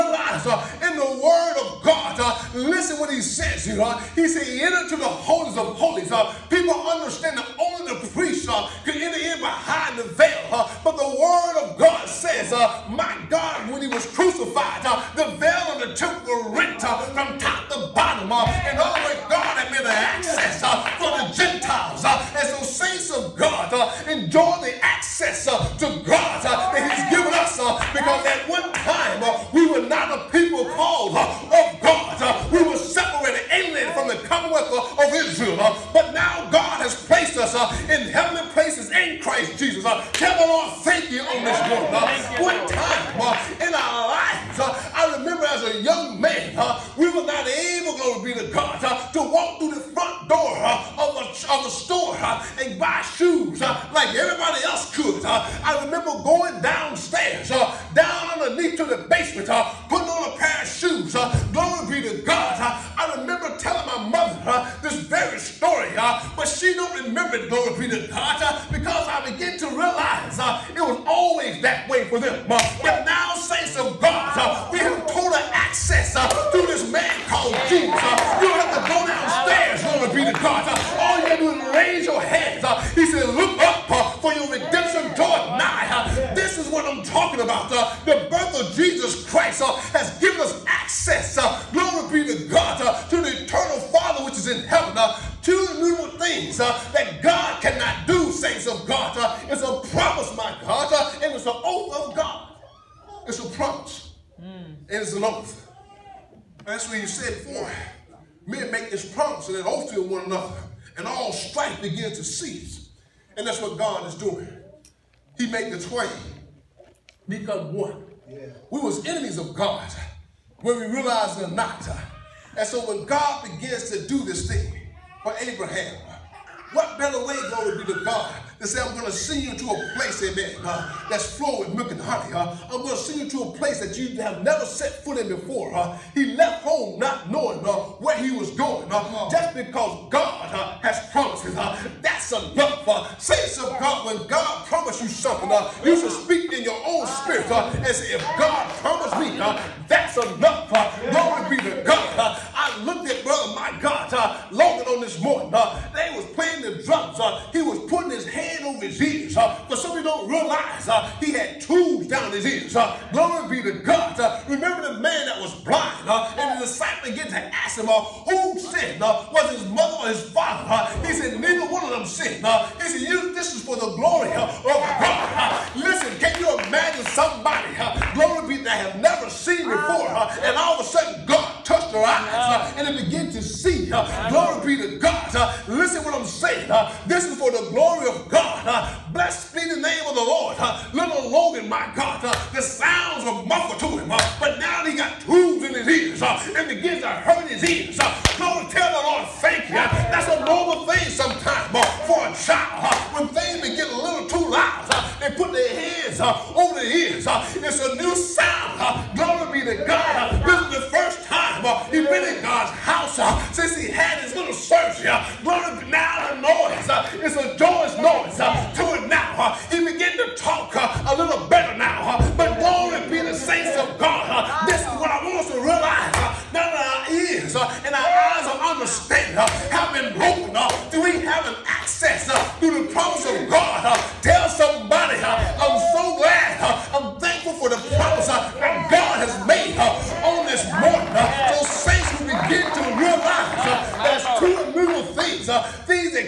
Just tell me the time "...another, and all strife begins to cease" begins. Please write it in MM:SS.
01:50.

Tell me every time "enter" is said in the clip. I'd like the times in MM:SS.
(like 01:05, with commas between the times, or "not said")
00:04, 00:09.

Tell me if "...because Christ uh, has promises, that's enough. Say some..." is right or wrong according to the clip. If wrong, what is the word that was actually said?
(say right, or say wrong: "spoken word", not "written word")
wrong: "God", not "Christ".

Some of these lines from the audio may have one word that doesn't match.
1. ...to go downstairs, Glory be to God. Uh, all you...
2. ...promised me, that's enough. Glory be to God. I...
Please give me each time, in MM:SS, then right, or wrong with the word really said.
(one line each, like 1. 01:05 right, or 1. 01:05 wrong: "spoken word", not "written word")
1. 01:18 right
2. 02:28 right.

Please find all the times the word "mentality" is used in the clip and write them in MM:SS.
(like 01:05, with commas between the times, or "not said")
not said.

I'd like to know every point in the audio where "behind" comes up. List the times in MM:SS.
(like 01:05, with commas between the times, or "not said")
00:09.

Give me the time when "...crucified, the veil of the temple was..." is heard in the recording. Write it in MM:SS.
00:14.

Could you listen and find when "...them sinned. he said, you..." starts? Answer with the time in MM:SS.
02:51.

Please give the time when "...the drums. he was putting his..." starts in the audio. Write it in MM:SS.
02:36.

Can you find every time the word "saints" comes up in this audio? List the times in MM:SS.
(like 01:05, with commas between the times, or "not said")
00:22, 01:13.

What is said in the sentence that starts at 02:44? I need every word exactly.
remember the man that was disciple get to ask him, uh, who sinned?